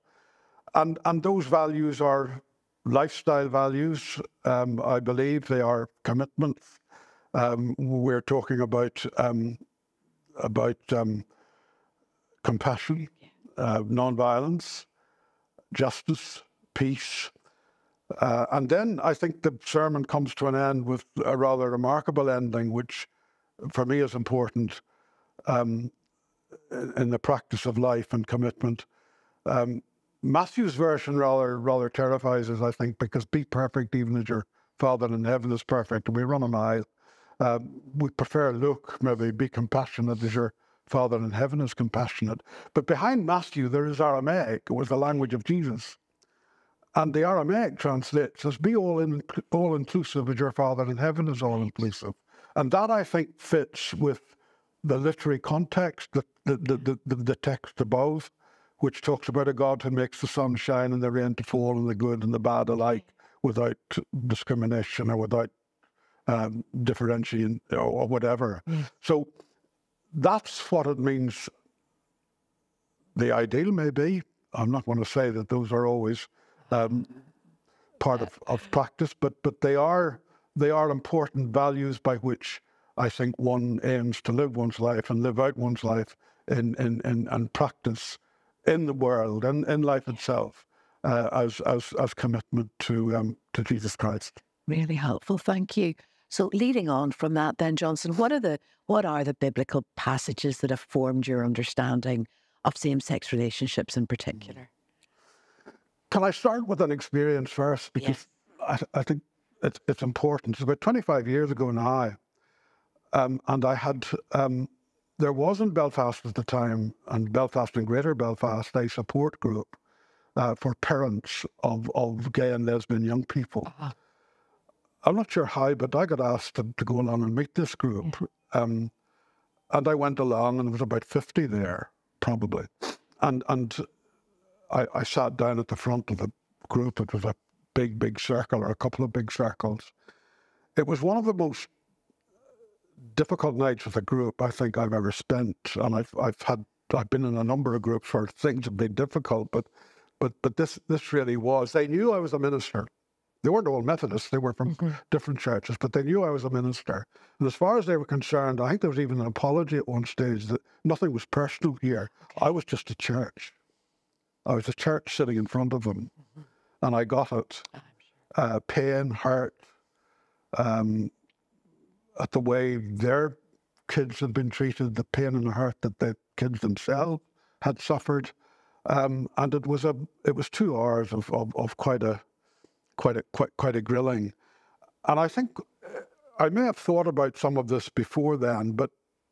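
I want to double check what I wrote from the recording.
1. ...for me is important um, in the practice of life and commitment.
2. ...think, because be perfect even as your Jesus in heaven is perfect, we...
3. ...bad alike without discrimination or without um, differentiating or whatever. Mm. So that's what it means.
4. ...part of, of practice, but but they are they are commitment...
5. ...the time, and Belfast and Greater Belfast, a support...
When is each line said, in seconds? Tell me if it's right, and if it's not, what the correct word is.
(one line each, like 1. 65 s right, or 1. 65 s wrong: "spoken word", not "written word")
1. 23 s right
2. 32 s wrong: "Father", not "Jesus"
3. 62 s right
4. 77 s wrong: "important", not "commitment"
5. 116 s right.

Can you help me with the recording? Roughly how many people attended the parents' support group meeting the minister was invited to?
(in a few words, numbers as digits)
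50.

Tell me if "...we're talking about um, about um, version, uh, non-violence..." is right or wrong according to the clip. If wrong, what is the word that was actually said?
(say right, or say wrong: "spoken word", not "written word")
wrong: "compassion", not "version".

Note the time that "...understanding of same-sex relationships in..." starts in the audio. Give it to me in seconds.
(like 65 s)
101 s.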